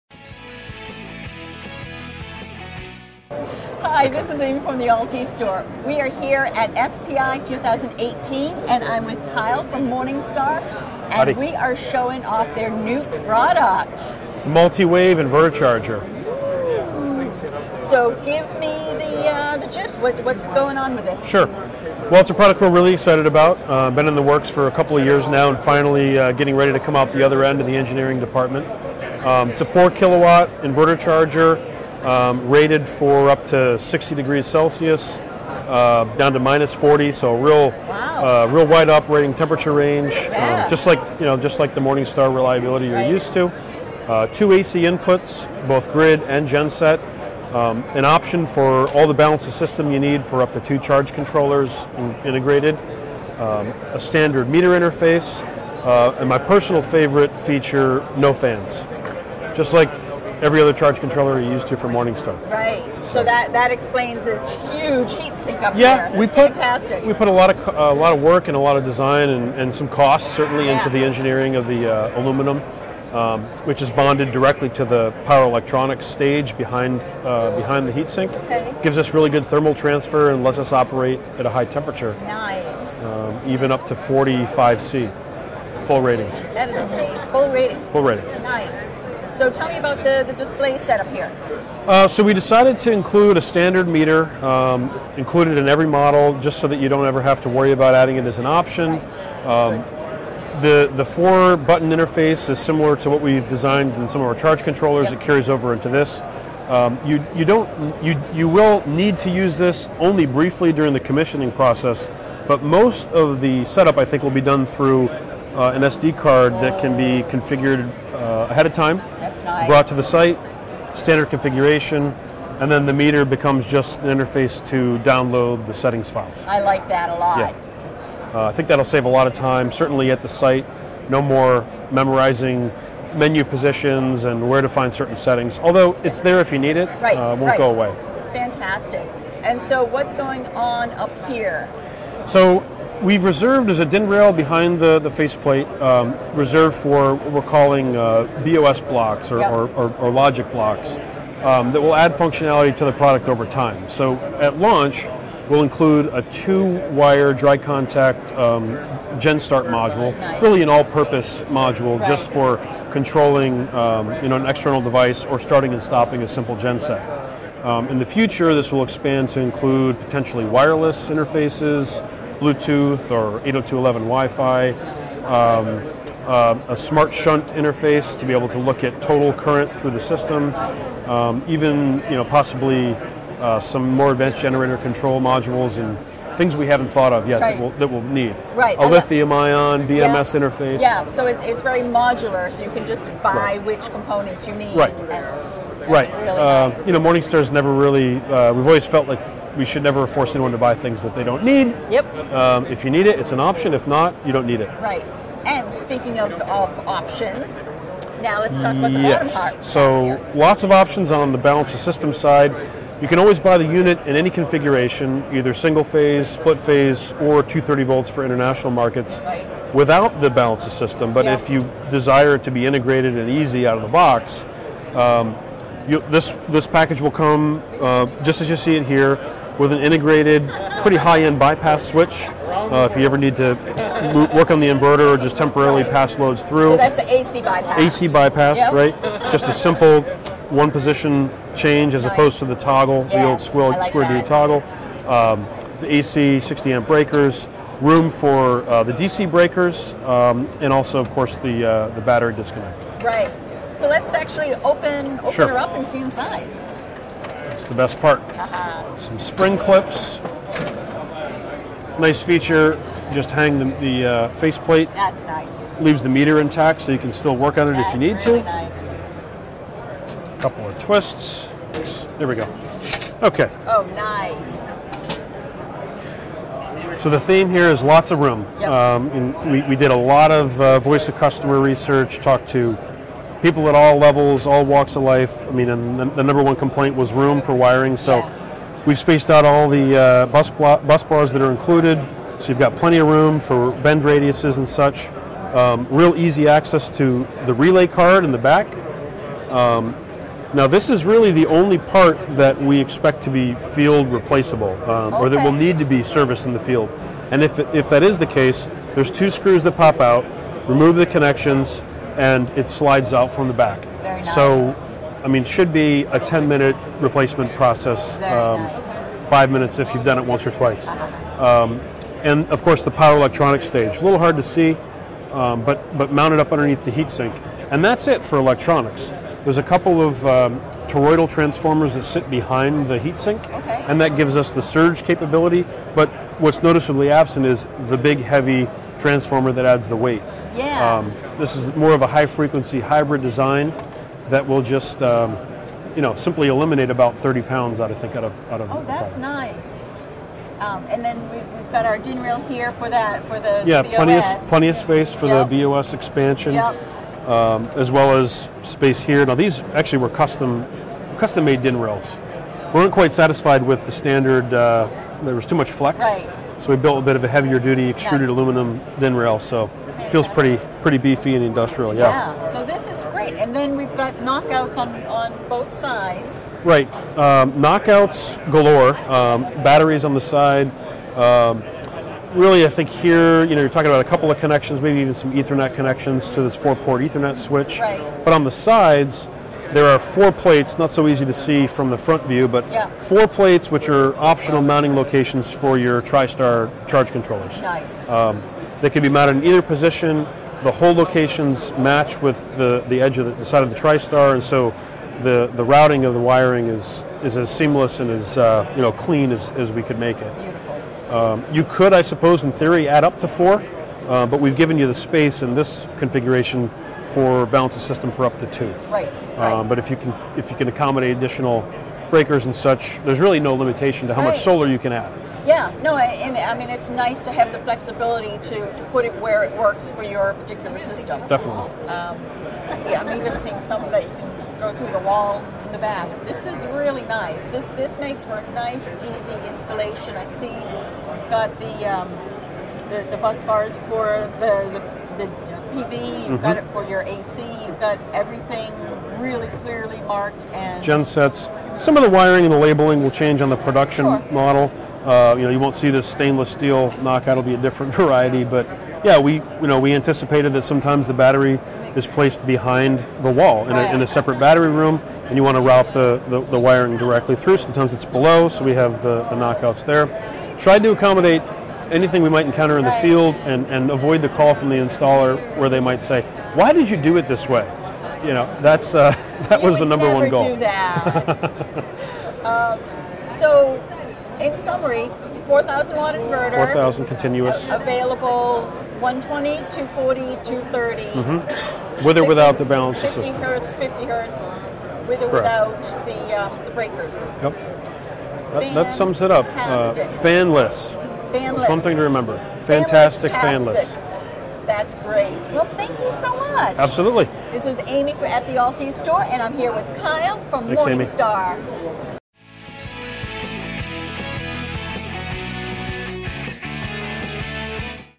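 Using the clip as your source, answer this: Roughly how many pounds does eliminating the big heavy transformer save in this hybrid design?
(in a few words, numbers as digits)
30 pounds.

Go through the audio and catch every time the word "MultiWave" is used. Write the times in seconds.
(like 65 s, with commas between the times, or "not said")
14 s.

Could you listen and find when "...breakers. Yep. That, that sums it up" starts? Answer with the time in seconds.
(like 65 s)
496 s.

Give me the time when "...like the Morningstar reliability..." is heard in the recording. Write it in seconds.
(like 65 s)
41 s.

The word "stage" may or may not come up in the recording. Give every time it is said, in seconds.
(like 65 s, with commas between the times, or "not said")
76 s, 323 s.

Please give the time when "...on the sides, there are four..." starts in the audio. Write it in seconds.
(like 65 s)
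388 s.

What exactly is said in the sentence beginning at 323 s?
A little hard to see, um, but, but mounted up underneath the heatsink.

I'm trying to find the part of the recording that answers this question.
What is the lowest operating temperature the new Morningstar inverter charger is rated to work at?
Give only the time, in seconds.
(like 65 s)
36 s.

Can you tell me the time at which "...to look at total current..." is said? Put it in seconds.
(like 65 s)
178 s.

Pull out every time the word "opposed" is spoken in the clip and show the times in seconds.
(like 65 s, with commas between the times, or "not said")
242 s.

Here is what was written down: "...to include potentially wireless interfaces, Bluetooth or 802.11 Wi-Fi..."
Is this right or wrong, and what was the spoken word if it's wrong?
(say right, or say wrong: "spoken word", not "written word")
right.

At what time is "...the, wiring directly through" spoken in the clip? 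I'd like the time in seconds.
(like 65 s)
466 s.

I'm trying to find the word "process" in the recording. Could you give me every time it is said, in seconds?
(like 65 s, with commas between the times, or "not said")
111 s, 317 s.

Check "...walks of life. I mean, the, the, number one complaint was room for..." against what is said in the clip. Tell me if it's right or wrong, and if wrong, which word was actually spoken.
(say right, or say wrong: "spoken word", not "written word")
right.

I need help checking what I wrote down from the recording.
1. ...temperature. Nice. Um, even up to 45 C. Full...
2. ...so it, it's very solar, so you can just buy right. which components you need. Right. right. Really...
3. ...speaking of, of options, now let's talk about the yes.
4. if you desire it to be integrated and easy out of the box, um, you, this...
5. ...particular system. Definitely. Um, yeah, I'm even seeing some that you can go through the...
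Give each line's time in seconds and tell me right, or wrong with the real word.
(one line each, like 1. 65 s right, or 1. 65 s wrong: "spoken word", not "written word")
1. 81 s right
2. 191 s wrong: "modular", not "solar"
3. 205 s right
4. 221 s right
5. 430 s right.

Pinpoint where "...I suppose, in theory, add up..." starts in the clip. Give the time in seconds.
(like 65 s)
411 s.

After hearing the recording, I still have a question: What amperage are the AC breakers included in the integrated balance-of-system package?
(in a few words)
60 amp.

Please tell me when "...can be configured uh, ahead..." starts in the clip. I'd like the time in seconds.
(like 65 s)
116 s.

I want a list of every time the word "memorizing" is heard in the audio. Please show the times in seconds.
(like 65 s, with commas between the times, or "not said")
131 s.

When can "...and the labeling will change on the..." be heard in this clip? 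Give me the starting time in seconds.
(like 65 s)
452 s.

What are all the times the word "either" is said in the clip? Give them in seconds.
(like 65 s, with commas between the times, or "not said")
215 s, 399 s.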